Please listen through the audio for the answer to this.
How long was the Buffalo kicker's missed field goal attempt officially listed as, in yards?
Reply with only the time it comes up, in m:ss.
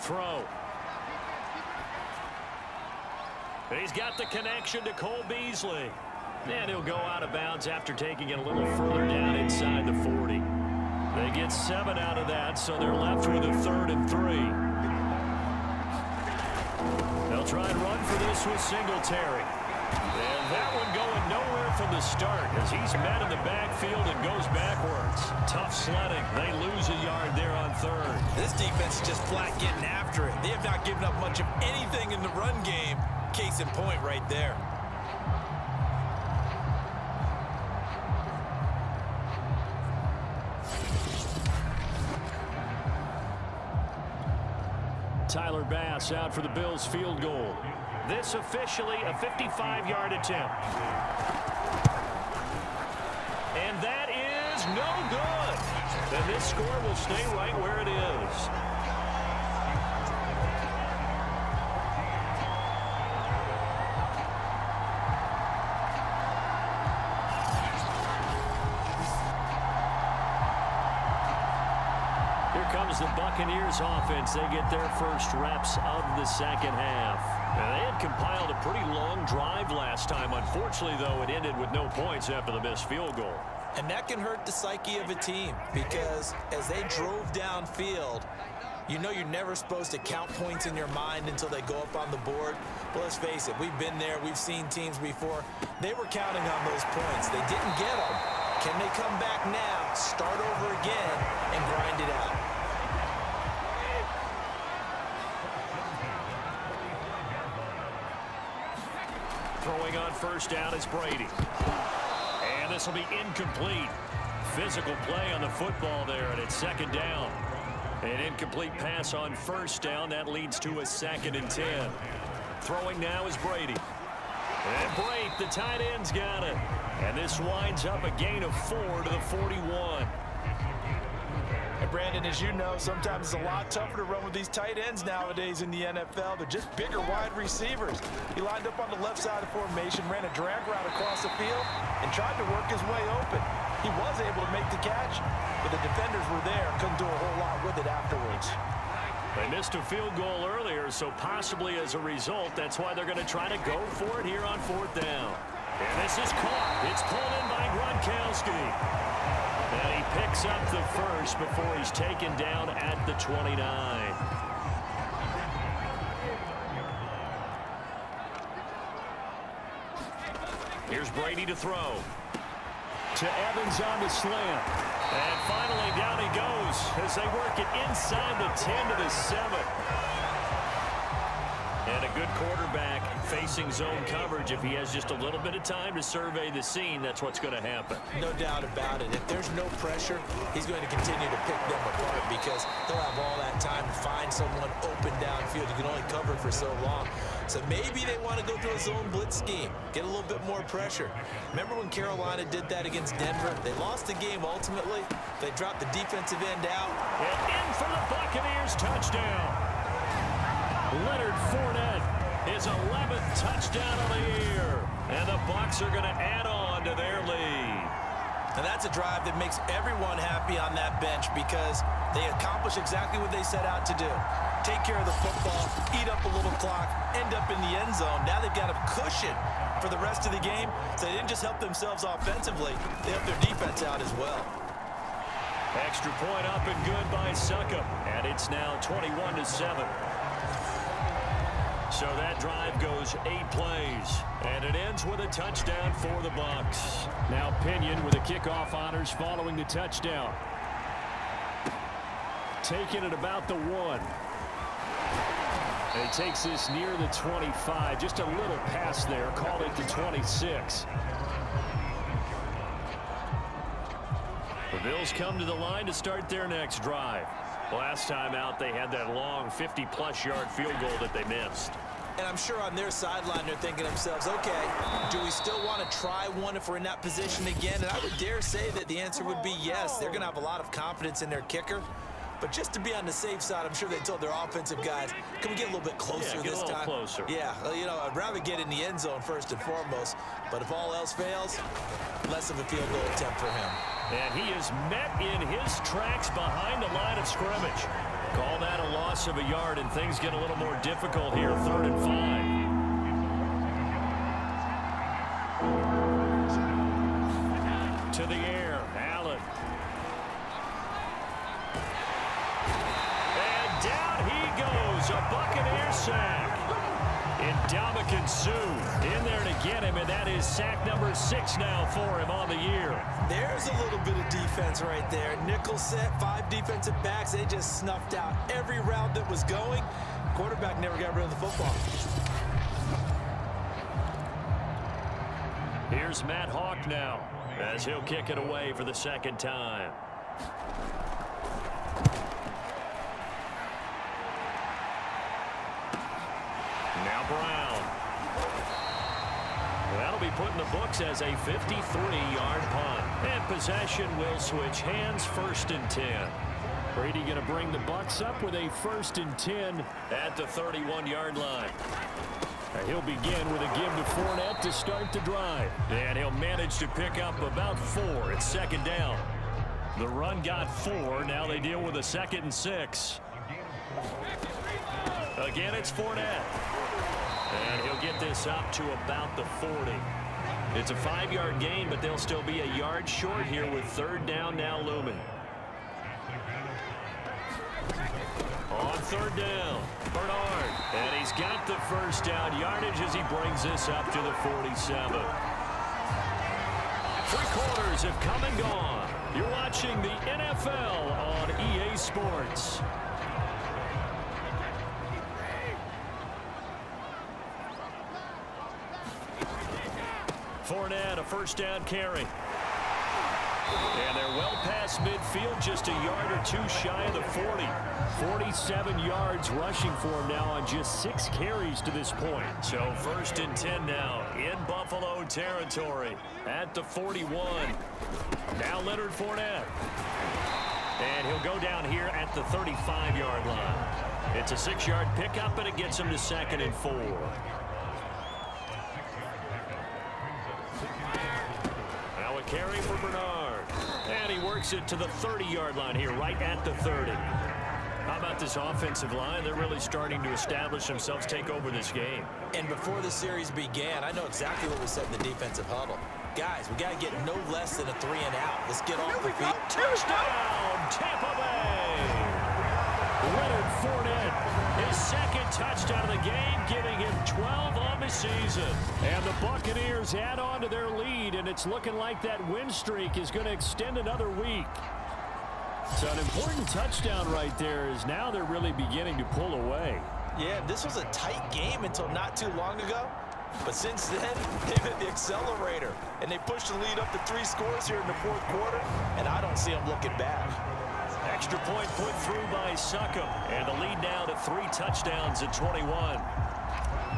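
0:49.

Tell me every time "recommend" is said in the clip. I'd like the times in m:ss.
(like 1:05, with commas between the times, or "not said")
not said.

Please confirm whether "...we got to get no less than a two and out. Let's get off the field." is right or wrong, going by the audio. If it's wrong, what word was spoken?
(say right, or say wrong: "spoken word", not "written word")
wrong: "three", not "two".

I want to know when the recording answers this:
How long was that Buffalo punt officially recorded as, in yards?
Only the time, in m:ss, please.
5:51.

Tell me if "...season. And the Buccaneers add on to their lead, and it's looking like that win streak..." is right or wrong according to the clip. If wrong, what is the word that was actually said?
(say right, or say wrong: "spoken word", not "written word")
right.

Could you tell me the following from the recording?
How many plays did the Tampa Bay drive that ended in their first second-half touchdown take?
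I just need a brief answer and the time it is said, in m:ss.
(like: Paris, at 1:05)
8, at 4:03.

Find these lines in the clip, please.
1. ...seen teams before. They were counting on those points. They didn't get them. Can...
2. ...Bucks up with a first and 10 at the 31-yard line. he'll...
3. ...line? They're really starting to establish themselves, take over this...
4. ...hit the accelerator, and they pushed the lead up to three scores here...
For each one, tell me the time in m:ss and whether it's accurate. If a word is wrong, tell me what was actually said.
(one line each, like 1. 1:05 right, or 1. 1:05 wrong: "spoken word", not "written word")
1. 1:34 right
2. 5:57 right
3. 7:29 right
4. 8:04 right.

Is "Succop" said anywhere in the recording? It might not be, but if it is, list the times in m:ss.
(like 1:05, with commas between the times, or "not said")
3:57, 8:12.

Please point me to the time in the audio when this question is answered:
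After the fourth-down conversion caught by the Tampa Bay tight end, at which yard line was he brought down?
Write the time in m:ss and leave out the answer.
2:43.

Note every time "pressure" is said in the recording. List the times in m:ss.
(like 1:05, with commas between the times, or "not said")
3:09, 3:20.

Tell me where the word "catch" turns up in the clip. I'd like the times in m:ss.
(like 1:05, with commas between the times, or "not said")
2:24.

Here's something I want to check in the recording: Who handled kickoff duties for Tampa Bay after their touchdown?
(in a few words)
Pinion.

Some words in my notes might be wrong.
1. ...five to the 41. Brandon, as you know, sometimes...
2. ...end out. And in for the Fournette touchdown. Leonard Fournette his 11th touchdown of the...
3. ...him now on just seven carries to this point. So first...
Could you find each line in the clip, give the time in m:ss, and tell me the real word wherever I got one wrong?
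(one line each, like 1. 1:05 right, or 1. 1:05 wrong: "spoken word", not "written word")
1. 2:08 wrong: "four", not "five"
2. 3:26 wrong: "Buccaneers", not "Fournette"
3. 7:00 wrong: "six", not "seven".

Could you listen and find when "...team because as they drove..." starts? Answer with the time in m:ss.
1:25.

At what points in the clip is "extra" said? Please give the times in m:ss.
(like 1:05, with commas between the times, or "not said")
3:55, 8:11.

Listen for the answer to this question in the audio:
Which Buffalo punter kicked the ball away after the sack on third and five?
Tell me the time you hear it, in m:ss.
5:36.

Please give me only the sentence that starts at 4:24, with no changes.
The Bills come to the line to start their next drive.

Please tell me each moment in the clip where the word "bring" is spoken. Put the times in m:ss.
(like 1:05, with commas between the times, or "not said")
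5:57, 6:33.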